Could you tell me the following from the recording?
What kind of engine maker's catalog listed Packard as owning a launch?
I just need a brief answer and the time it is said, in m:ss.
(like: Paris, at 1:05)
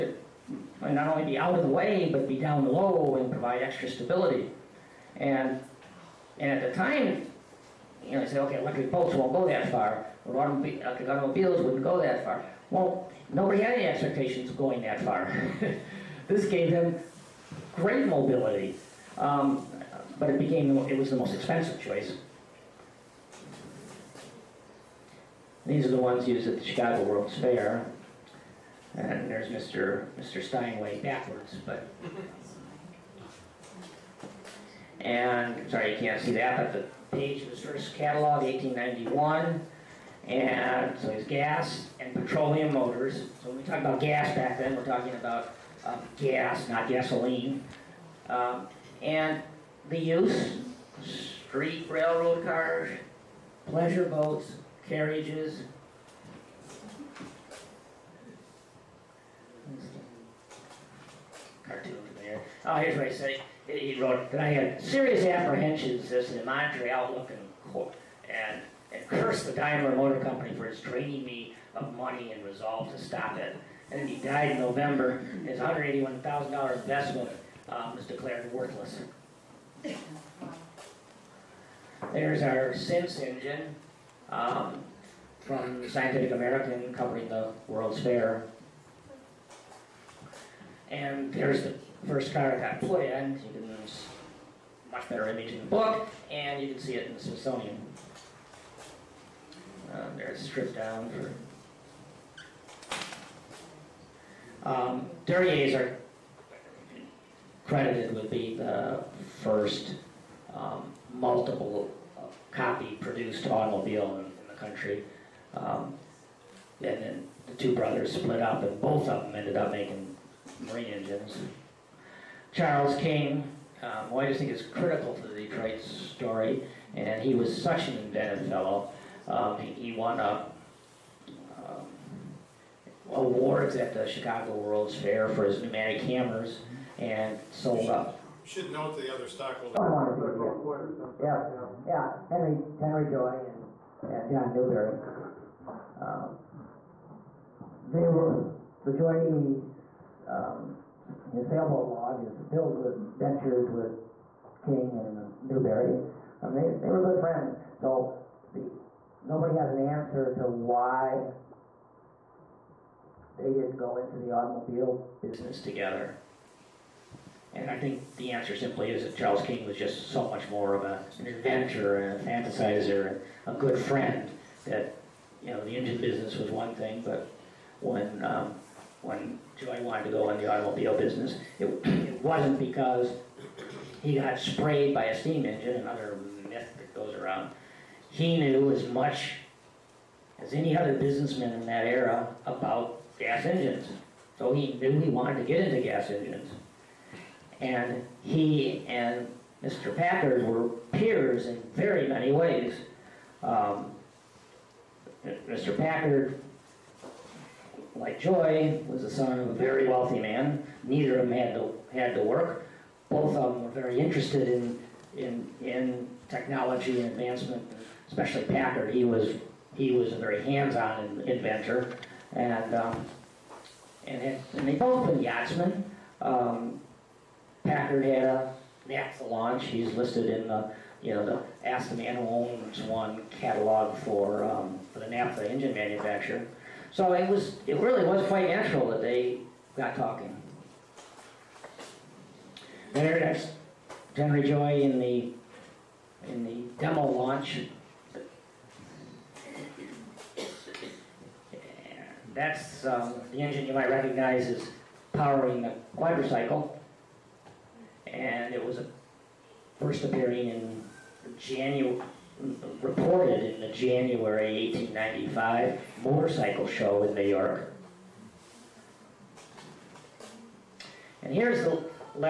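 naphtha engine, at 3:55.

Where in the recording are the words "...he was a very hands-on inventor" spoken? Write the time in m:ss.
3:39.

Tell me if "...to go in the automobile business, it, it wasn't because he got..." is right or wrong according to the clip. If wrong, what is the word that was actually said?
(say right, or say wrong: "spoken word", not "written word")
right.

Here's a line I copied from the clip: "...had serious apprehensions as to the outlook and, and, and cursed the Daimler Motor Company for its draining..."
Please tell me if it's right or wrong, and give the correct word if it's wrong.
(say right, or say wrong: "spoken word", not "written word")
right.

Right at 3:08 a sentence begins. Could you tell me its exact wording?
He knew as much as any other businessman in that era about gas engines.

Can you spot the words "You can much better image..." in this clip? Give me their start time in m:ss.
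1:33.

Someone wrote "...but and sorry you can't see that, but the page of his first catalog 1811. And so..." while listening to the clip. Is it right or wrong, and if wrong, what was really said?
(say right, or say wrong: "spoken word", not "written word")
wrong: "1891", not "1811".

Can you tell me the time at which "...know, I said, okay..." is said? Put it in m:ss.
0:08.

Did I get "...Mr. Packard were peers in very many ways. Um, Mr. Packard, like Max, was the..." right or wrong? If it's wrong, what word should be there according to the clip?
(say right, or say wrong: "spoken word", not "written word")
wrong: "Joy", not "Max".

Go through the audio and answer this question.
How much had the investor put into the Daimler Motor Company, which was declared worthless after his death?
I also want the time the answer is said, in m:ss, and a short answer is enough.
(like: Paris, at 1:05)
$181,000, at 1:15.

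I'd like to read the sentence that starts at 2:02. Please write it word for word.
Charles King, um, well, I just think is critical to the Detroit story, and he was such an inventive fellow.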